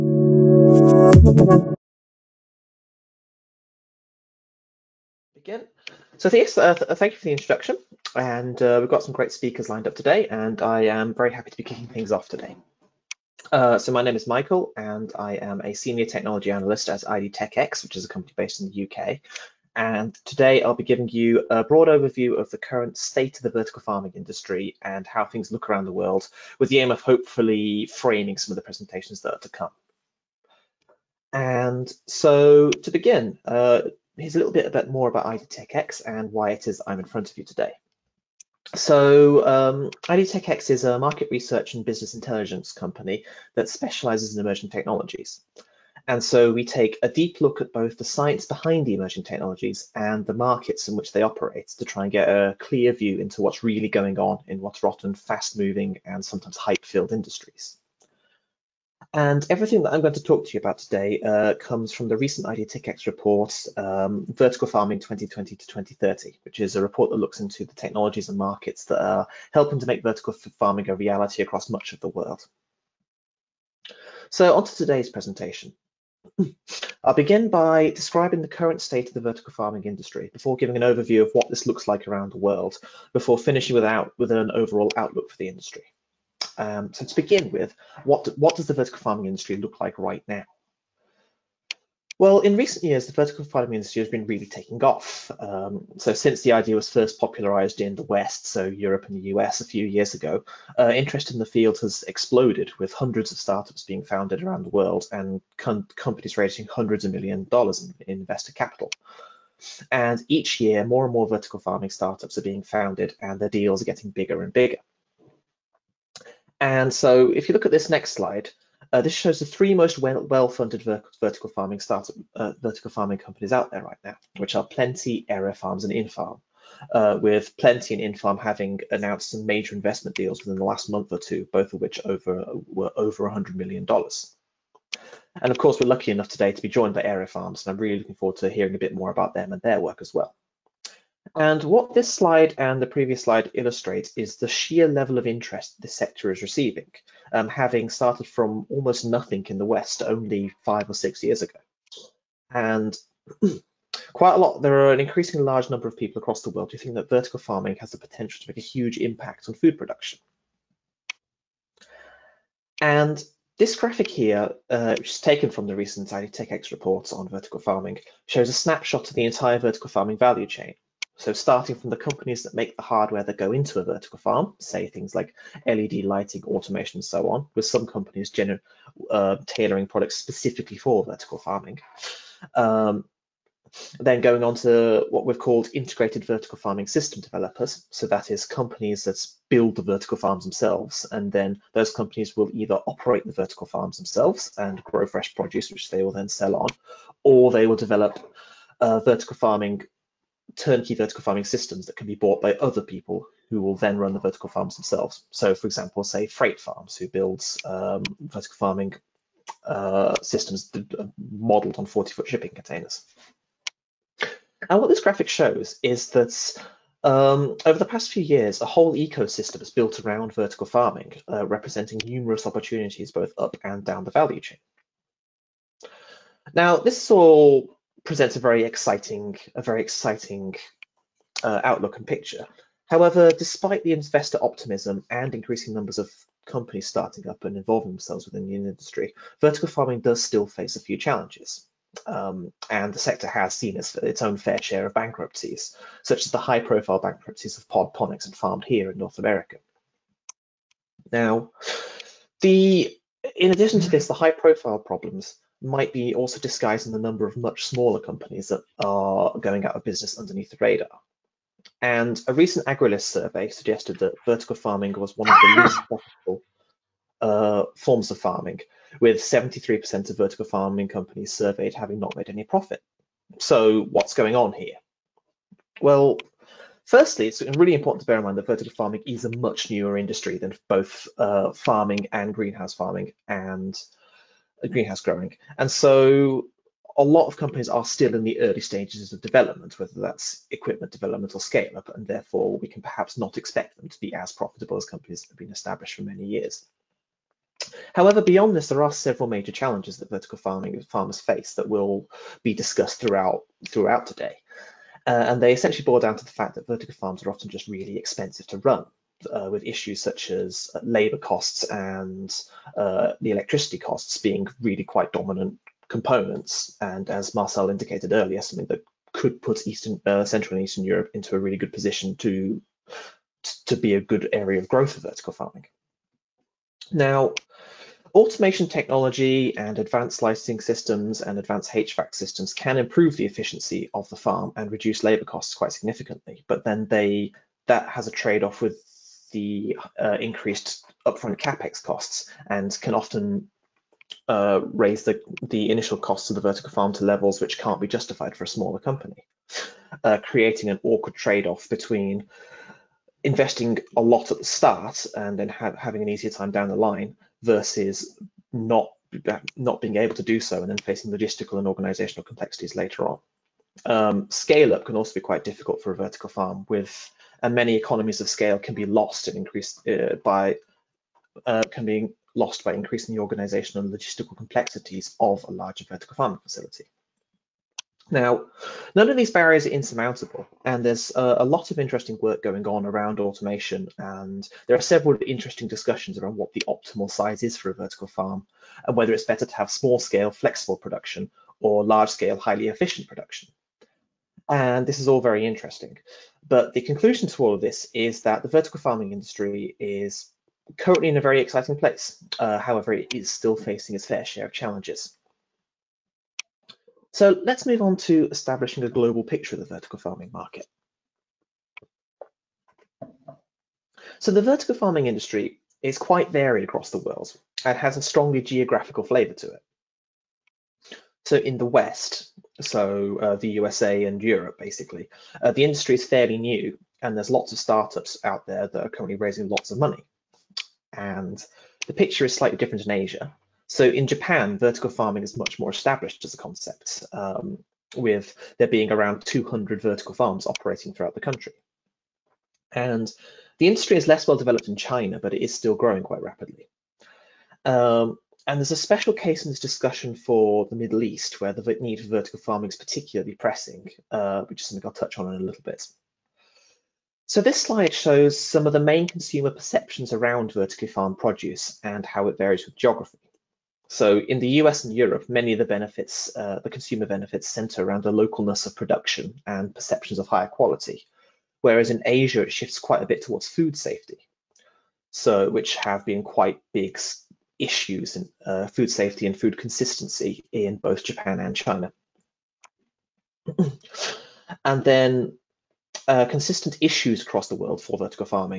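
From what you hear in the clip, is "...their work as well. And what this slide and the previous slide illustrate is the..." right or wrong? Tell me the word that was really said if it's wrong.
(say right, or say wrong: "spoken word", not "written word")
right.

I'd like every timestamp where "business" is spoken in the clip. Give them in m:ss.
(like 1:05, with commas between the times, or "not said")
0:41, 4:19.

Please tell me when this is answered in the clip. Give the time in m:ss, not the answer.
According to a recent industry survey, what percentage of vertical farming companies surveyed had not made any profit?
4:29.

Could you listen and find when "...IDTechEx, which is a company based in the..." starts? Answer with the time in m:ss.
0:17.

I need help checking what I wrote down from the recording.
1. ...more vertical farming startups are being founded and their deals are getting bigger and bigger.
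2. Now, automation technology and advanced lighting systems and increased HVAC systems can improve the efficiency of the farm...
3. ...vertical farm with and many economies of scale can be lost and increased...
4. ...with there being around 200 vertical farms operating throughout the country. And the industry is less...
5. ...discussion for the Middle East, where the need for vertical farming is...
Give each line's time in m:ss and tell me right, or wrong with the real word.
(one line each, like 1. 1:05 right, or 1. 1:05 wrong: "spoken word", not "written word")
1. 1:51 right
2. 5:26 wrong: "advanced", not "increased"
3. 6:06 right
4. 7:17 right
5. 7:29 right.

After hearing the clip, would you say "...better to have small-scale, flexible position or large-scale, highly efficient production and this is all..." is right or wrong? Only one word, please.
wrong.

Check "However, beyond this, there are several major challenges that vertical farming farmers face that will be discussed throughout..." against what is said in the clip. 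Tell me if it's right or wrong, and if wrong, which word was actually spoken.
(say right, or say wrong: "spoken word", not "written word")
right.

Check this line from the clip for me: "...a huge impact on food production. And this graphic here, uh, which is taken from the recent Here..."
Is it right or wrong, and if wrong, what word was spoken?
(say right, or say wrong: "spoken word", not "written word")
wrong: "IDTechX", not "Here".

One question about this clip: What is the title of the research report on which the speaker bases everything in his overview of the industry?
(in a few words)
Vertical Farming 2020 to 2030.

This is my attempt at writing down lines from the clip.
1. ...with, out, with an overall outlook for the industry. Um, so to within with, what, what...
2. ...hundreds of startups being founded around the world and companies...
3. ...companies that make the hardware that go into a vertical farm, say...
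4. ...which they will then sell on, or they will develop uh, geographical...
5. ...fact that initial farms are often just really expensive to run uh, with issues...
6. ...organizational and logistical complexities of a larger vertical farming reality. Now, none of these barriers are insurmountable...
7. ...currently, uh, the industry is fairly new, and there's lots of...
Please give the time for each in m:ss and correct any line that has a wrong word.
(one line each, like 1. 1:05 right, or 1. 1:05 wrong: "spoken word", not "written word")
1. 1:23 wrong: "begin", not "within"
2. 1:42 right
3. 2:51 right
4. 3:15 wrong: "vertical", not "geographical"
5. 5:06 wrong: "vertical", not "initial"
6. 6:13 wrong: "facility", not "reality"
7. 7:04 wrong: "basically", not "currently".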